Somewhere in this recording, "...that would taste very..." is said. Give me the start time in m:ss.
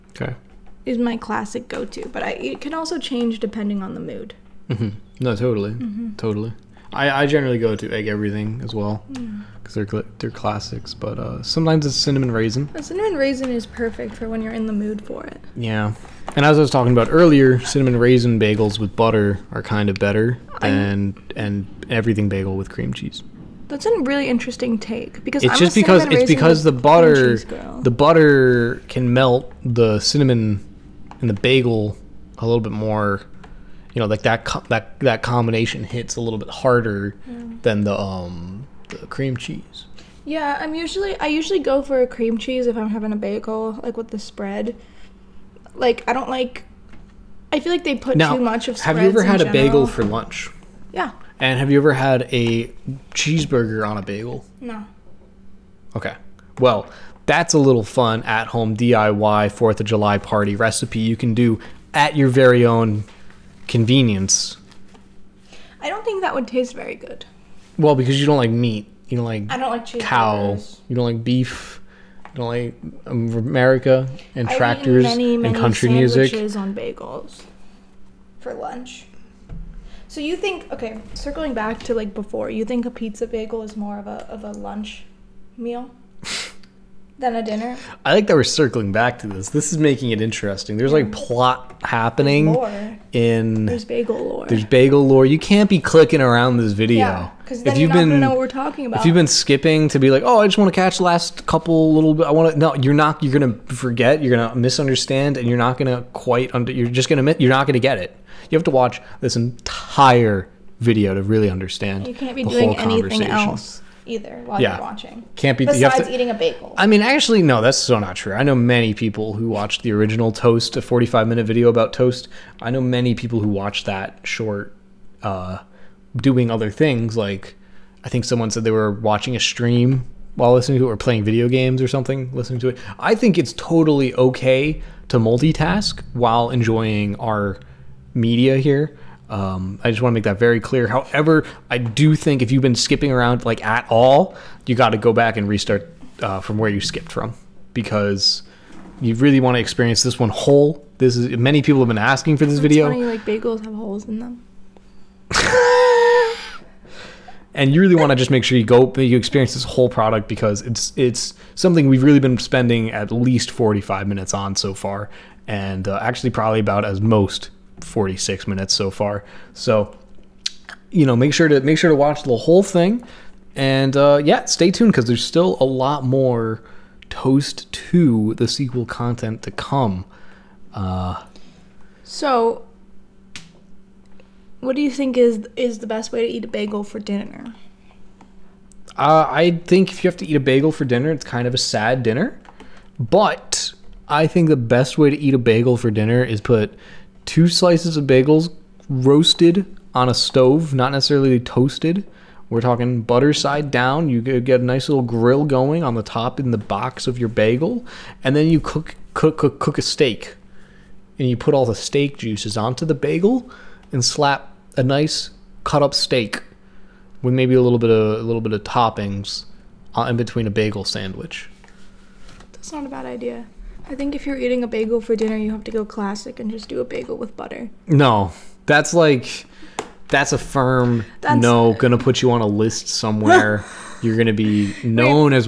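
1:06.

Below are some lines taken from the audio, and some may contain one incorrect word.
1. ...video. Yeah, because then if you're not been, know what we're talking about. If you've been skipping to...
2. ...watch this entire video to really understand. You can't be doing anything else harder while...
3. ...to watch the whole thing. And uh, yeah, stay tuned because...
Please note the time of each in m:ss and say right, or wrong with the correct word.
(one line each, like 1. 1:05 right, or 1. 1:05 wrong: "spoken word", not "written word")
1. 1:36 right
2. 1:48 wrong: "either", not "harder"
3. 2:51 right.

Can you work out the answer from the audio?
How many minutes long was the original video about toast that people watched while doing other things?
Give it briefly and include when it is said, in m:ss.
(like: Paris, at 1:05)
45, at 2:00.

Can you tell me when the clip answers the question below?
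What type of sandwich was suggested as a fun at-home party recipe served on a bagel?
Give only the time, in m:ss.
0:53.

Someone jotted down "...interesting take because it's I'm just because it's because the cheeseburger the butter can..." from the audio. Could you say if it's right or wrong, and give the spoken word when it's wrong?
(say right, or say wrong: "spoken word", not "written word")
wrong: "butter", not "cheeseburger".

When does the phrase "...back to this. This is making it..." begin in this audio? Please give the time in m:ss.
1:28.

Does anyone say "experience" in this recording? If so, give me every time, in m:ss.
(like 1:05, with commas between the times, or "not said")
2:29, 2:39.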